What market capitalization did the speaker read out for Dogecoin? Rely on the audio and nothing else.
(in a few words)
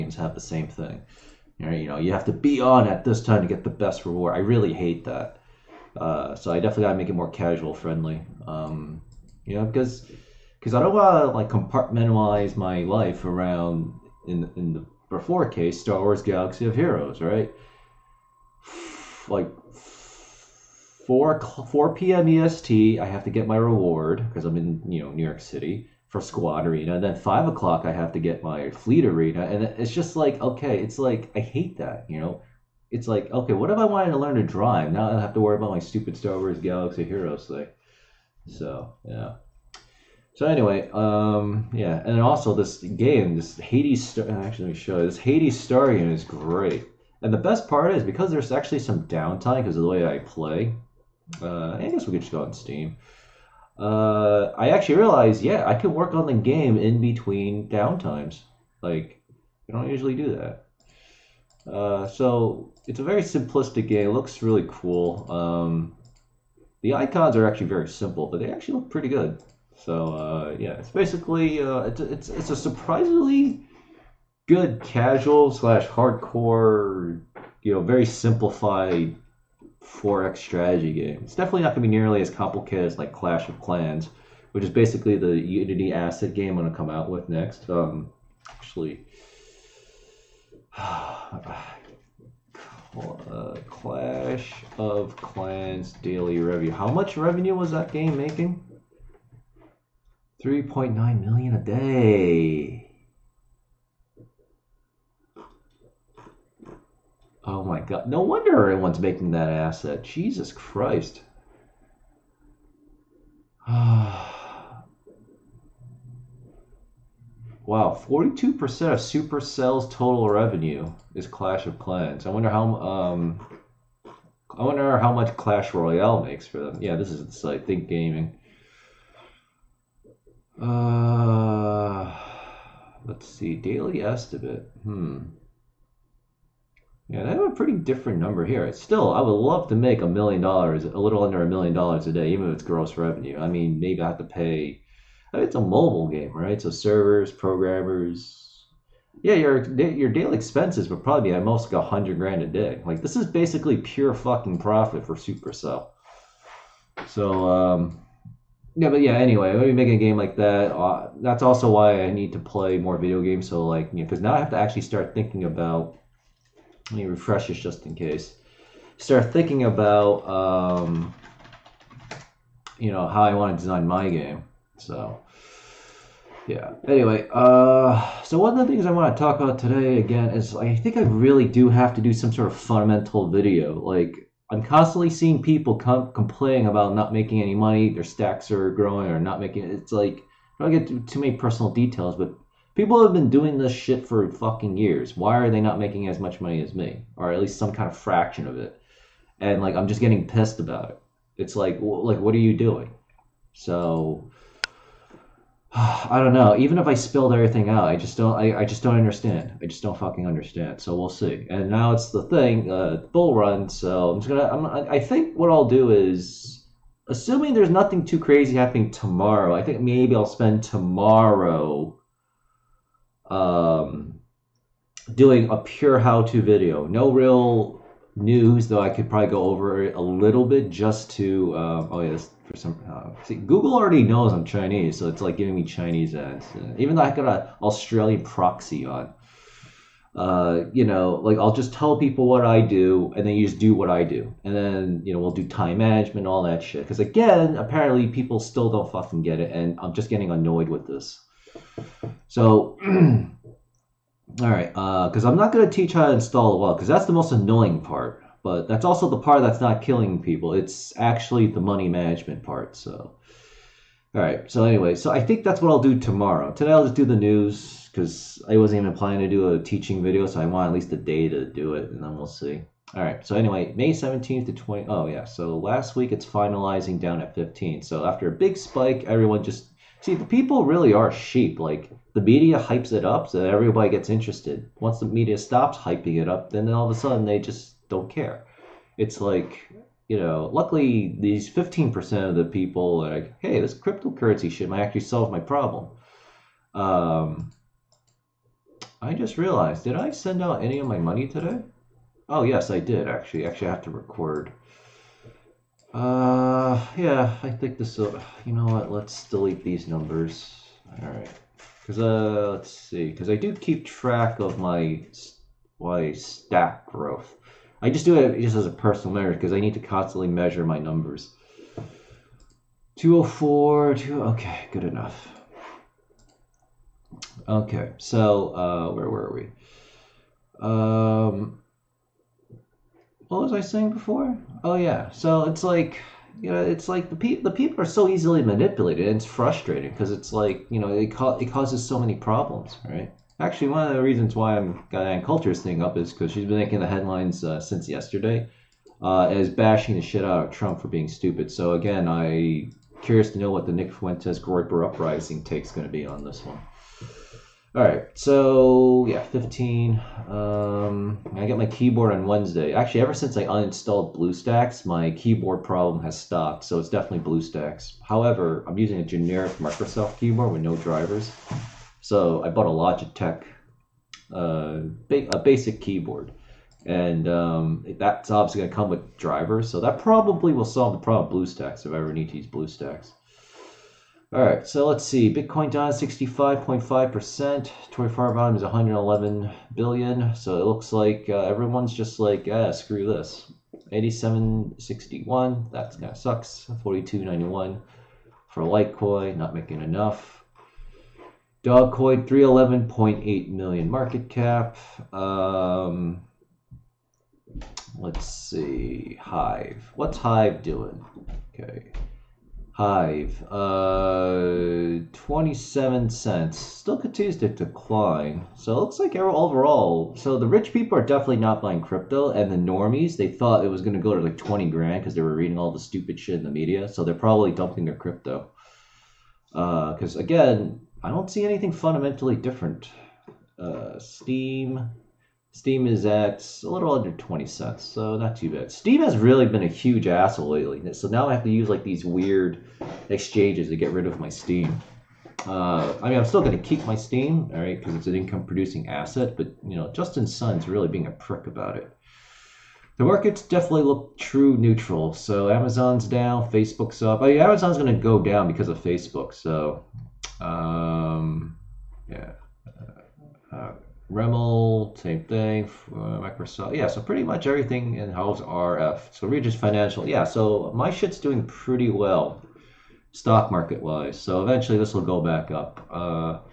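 311.8 million.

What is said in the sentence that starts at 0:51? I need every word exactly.
Uh, I guess we could just go on Steam.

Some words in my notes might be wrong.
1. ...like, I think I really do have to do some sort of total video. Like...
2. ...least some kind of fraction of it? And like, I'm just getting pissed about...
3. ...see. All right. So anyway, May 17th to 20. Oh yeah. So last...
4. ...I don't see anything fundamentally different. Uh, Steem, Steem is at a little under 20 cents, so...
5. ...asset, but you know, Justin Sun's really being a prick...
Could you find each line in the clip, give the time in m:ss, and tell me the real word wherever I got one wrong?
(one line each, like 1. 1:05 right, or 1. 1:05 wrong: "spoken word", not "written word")
1. 3:00 wrong: "fundamental", not "total"
2. 3:17 right
3. 4:32 right
4. 7:11 right
5. 7:28 right.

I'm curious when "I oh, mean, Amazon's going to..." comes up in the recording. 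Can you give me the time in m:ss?
7:37.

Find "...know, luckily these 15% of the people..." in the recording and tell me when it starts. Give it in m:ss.
4:50.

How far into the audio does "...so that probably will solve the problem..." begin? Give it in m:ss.
6:19.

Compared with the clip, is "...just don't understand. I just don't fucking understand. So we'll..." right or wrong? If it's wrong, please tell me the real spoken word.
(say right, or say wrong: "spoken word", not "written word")
right.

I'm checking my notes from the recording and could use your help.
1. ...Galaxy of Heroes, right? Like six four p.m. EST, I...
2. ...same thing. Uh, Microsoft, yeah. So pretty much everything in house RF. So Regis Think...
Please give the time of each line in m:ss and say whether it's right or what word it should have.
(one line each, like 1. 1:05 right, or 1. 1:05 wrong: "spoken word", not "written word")
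1. 0:16 wrong: "four", not "six"
2. 7:44 wrong: "Financial", not "Think".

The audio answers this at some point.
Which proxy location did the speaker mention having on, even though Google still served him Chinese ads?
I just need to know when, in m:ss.
3:57.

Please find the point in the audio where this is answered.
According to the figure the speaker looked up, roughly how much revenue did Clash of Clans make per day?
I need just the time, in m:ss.
1:40.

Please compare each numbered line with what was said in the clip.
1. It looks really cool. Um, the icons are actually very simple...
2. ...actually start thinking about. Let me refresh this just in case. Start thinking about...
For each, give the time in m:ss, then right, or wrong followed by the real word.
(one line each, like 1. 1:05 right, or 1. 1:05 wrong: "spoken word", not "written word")
1. 1:04 right
2. 2:44 right.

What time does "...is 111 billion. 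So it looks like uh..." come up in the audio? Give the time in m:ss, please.
6:28.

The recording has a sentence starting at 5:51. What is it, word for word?
So again, I curious to know what the Nick Fuentes Groyper uprising take's going to be on this one.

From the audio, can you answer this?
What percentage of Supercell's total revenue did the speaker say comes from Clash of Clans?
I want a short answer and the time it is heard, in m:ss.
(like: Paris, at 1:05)
42%, at 1:58.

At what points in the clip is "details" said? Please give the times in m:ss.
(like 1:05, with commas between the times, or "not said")
3:11.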